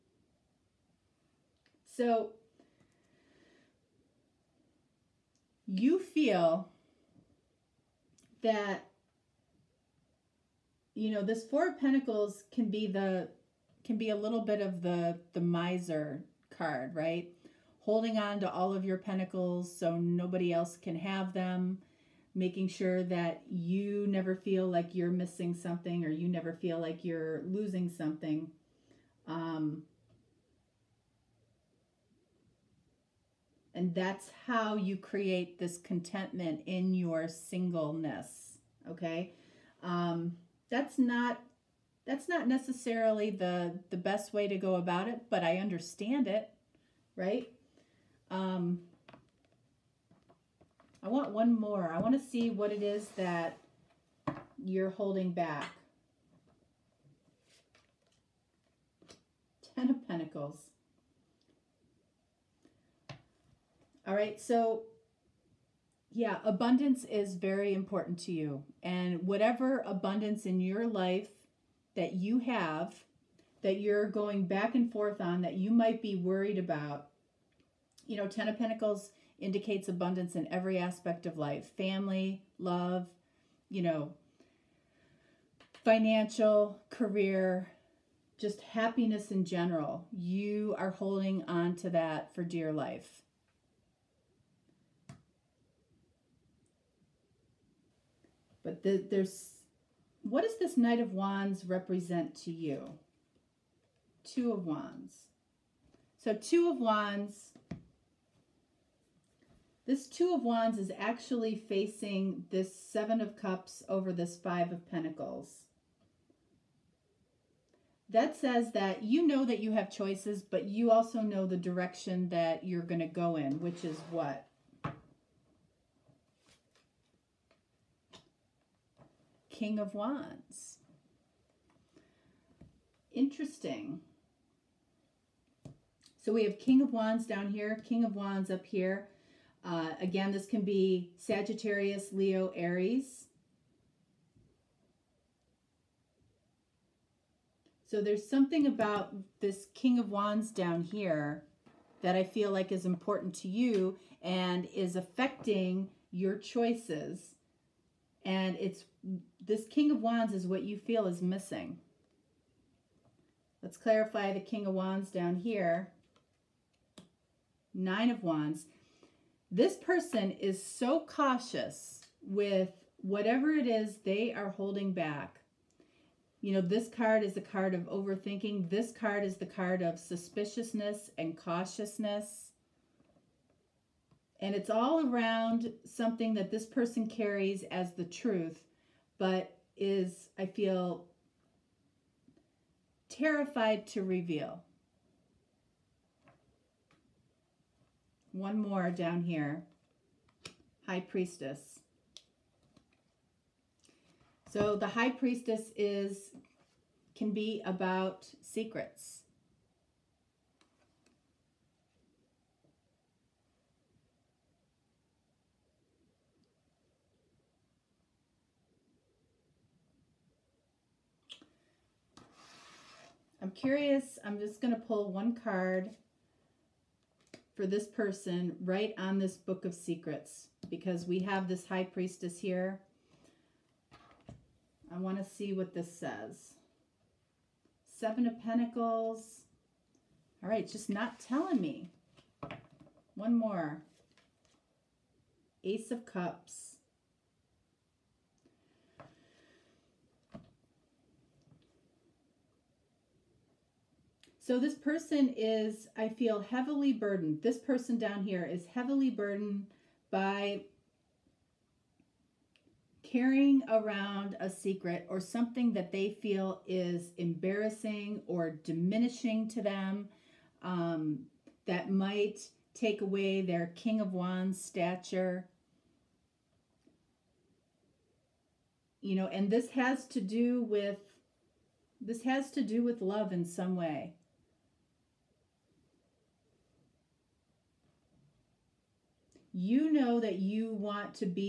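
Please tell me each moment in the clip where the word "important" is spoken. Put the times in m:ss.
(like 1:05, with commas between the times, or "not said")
1:07, 2:32.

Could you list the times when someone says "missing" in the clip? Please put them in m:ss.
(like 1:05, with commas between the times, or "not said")
0:25, 2:41.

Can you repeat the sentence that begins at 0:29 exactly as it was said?
Um, and that's how you create this contentment in your singleness.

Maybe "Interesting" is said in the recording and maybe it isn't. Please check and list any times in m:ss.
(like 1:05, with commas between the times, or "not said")
2:13.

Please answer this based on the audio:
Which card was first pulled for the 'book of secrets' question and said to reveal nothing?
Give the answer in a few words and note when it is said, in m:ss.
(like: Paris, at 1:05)
Seven of Pentacles, at 3:57.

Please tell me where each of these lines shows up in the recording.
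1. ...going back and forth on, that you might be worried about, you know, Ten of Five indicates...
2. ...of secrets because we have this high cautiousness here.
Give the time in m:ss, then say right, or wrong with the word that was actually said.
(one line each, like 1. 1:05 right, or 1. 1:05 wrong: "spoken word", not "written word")
1. 1:14 wrong: "Pentacles", not "Five"
2. 3:49 wrong: "priestess", not "cautiousness".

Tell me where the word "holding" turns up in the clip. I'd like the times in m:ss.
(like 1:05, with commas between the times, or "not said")
0:17, 0:54, 1:30, 2:54.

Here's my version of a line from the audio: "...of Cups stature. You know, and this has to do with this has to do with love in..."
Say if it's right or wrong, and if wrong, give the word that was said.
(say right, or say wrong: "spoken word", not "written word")
wrong: "Wands", not "Cups".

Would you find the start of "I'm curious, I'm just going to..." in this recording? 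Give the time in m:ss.
3:43.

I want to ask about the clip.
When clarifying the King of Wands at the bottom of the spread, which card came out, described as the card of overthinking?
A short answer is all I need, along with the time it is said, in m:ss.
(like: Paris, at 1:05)
Nine of Wands, at 2:47.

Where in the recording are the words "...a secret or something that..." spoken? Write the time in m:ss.
4:24.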